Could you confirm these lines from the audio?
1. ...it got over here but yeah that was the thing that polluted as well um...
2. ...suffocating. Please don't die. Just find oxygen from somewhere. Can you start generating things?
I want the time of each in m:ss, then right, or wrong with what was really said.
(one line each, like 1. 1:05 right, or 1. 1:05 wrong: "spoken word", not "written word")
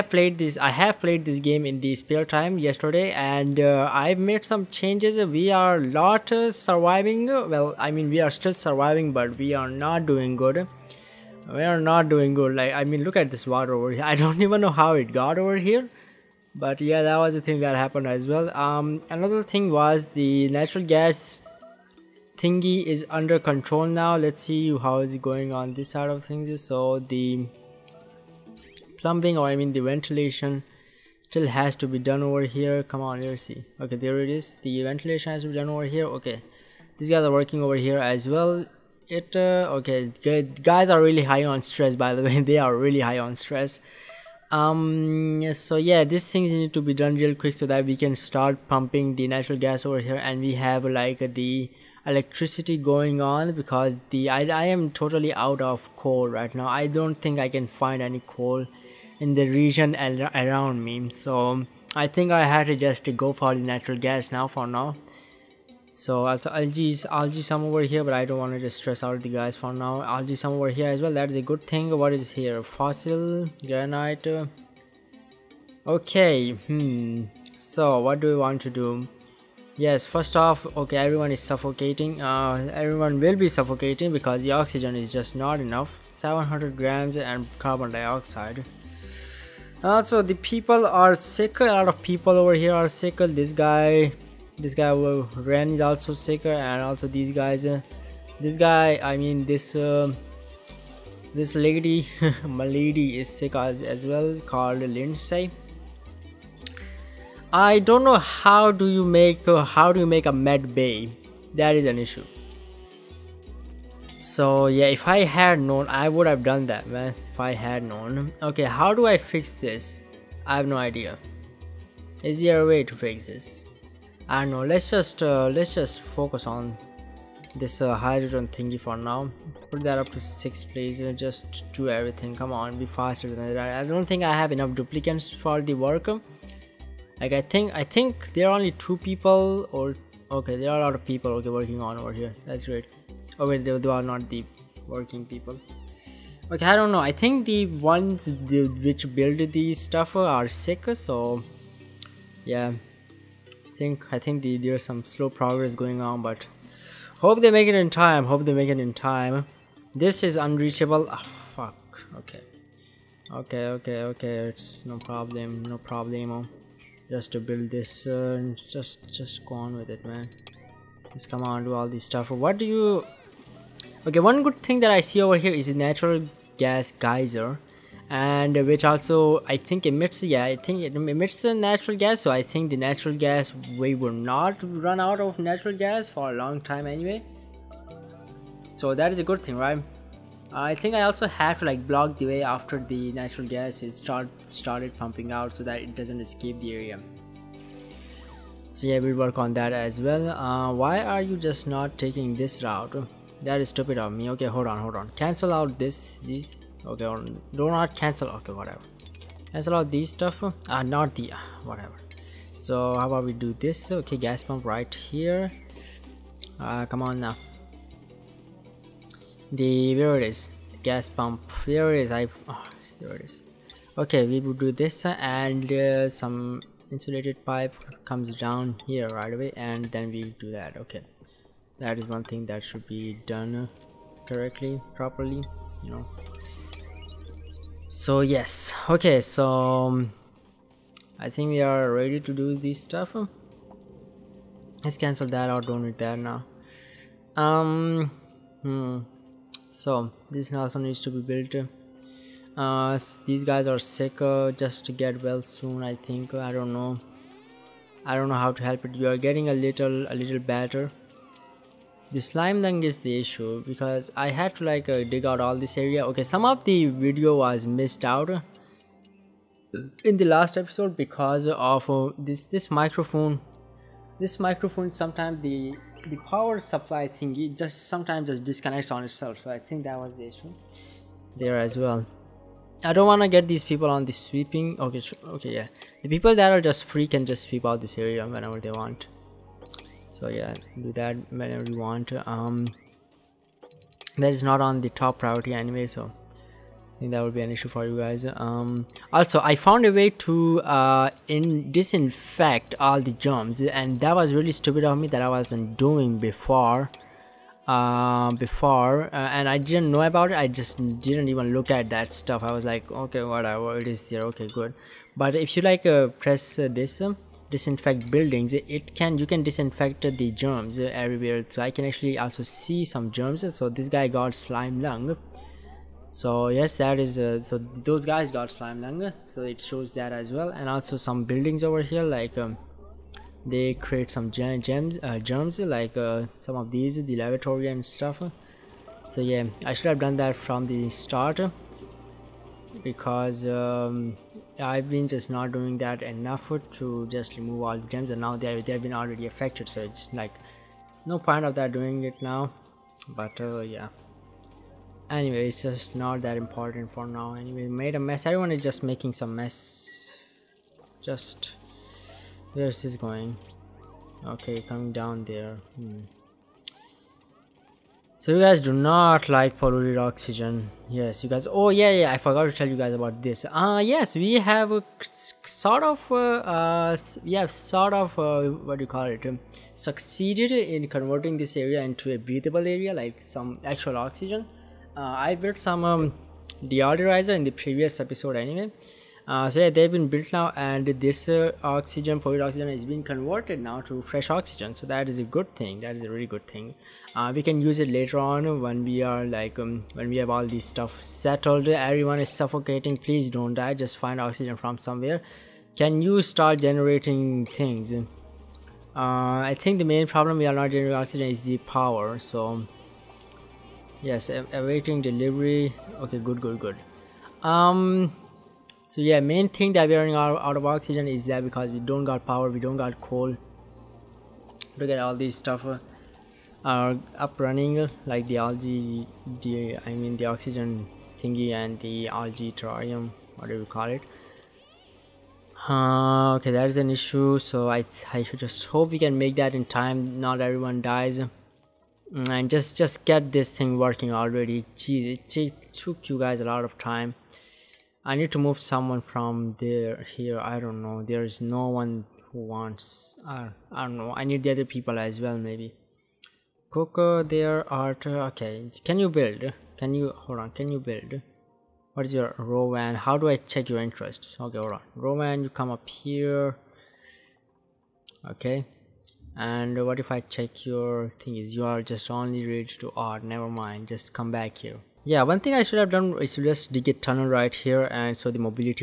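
1. 0:14 wrong: "happened", not "polluted"
2. 6:42 right.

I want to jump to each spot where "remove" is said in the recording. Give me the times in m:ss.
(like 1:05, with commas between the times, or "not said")
5:47.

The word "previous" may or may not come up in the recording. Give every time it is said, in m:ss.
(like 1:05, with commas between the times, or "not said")
6:27.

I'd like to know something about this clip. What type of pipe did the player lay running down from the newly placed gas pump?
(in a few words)
insulated pipe.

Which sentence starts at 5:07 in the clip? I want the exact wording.
Uh, before, uh, and I didn't know about it.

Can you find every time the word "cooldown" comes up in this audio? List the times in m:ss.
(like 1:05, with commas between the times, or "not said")
not said.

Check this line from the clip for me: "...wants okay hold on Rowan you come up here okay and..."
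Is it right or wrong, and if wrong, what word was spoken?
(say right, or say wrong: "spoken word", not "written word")
wrong: "interests", not "wants".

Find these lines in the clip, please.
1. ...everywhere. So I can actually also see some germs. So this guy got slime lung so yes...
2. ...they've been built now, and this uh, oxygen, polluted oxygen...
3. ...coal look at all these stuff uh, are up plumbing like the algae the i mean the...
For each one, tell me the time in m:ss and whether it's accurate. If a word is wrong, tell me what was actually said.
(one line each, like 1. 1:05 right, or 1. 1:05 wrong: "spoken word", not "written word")
1. 5:20 right
2. 6:29 right
3. 7:03 wrong: "running", not "plumbing".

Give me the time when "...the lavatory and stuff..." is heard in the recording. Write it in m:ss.
5:37.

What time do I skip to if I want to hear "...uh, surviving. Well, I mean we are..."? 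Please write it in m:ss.
0:06.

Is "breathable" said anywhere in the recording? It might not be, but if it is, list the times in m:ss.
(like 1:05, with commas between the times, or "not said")
6:22.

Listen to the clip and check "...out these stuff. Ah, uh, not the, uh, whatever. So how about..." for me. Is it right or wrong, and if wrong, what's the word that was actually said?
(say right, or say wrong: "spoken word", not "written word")
right.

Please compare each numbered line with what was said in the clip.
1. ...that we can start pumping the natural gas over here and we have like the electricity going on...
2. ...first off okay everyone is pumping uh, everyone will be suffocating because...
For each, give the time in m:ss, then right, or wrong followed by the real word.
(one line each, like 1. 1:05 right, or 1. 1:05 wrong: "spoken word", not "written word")
1. 0:47 right
2. 1:20 wrong: "suffocating", not "pumping".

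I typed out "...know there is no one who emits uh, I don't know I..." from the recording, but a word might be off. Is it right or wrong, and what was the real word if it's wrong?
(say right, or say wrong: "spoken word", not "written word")
wrong: "wants", not "emits".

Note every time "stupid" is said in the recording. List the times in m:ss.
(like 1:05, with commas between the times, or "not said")
3:23, 5:04.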